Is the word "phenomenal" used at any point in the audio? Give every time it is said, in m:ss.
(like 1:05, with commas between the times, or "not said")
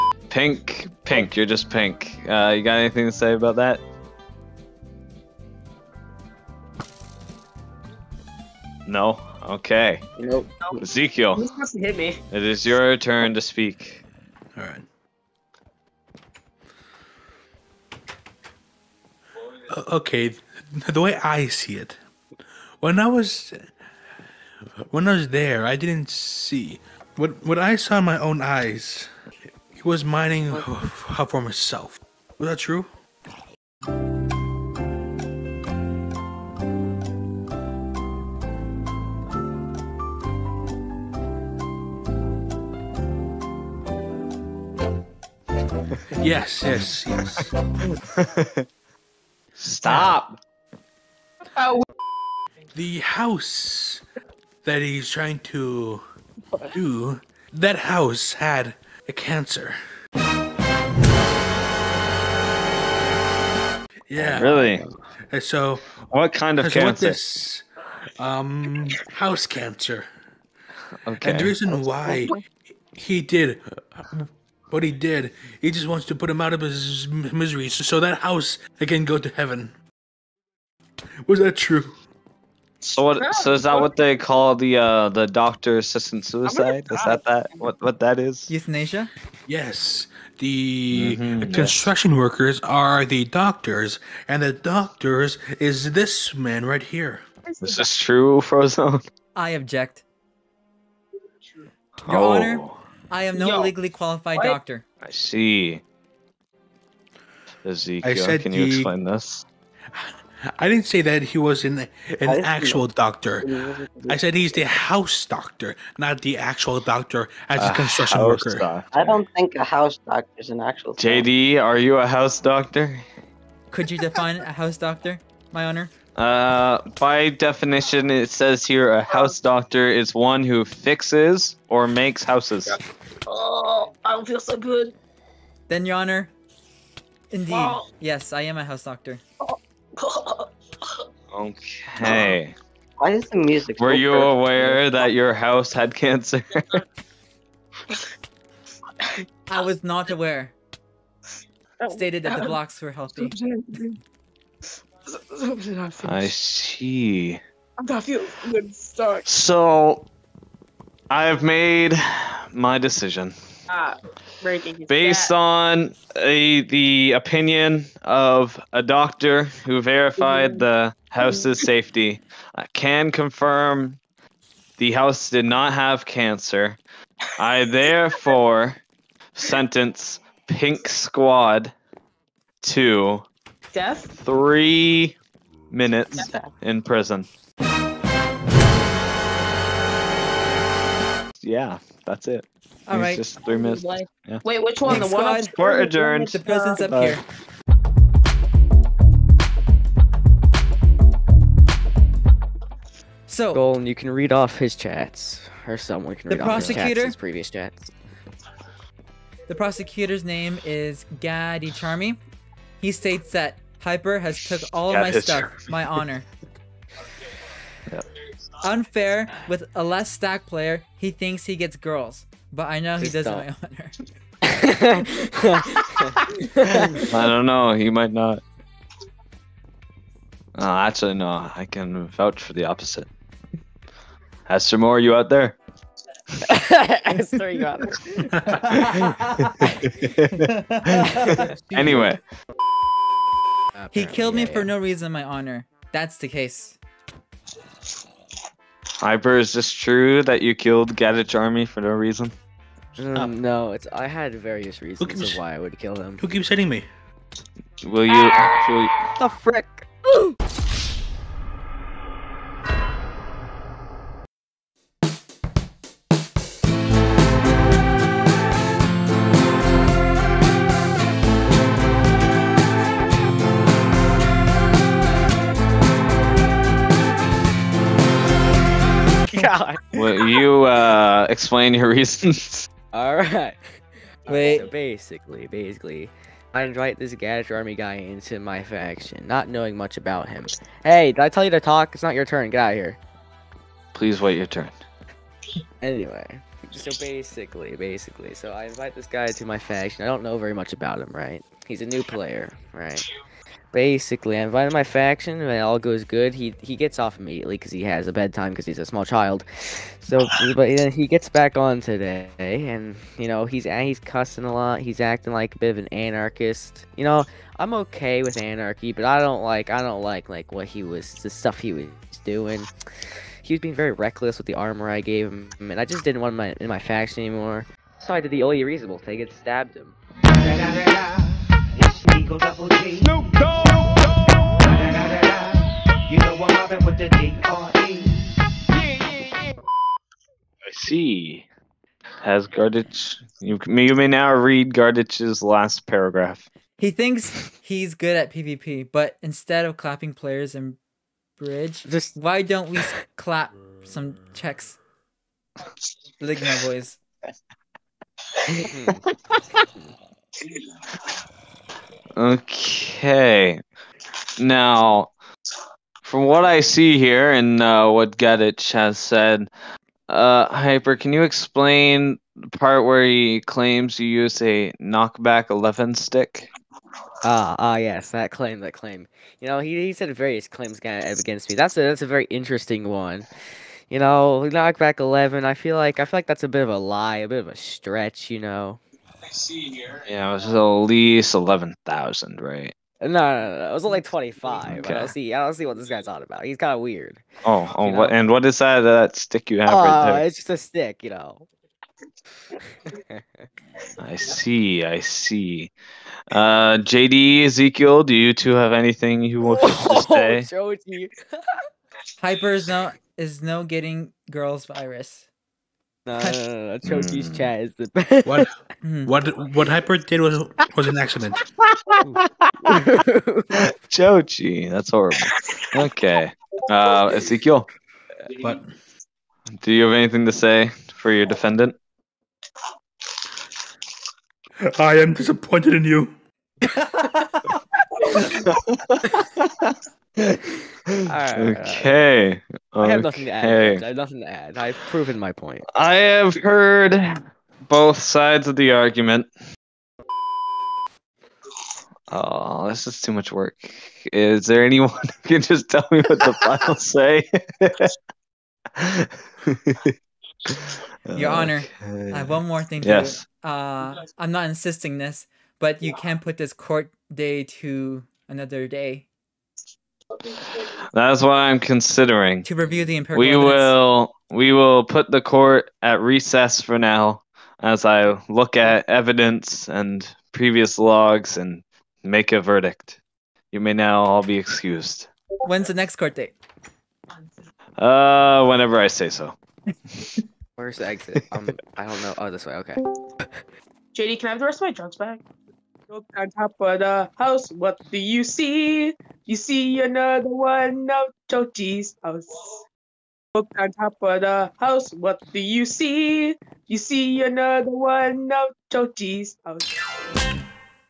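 not said.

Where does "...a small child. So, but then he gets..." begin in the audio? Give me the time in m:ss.
5:08.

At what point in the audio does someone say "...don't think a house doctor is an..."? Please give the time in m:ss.
1:59.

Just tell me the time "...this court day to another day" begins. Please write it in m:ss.
7:46.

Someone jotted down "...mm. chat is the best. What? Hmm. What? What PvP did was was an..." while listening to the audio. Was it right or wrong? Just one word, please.
wrong.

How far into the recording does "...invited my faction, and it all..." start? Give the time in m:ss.
5:04.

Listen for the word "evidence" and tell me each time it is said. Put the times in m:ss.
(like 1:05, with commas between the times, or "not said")
7:53, 7:58.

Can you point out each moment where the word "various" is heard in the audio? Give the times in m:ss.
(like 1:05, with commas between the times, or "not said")
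4:14, 6:20.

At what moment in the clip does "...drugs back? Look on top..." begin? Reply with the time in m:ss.
8:14.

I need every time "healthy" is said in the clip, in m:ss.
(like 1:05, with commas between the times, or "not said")
2:32.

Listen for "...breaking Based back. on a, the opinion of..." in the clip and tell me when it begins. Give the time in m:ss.
2:44.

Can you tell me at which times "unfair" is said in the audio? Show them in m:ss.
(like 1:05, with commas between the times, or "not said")
3:38.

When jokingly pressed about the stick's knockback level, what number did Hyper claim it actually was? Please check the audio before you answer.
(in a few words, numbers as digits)
25.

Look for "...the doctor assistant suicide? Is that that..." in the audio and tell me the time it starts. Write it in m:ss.
1:25.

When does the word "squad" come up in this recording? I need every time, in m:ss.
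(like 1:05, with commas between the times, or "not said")
3:00, 3:15.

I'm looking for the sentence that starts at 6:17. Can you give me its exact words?
Ah, ah, yes, that claim, that claim.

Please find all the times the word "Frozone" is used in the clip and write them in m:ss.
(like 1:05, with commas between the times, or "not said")
1:38.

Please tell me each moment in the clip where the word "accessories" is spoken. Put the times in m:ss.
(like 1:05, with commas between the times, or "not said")
not said.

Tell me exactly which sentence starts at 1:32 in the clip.
workers are the doctors, and the doctors is this man right here.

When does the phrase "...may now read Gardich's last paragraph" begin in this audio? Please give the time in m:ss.
5:43.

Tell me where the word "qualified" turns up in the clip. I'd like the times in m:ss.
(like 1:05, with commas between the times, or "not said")
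1:43.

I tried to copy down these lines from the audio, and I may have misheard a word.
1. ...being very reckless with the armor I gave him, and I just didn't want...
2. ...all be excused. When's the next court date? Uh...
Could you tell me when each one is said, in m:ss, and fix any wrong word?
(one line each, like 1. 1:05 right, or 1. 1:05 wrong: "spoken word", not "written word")
1. 5:23 right
2. 8:04 right.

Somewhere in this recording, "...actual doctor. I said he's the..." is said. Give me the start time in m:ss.
1:52.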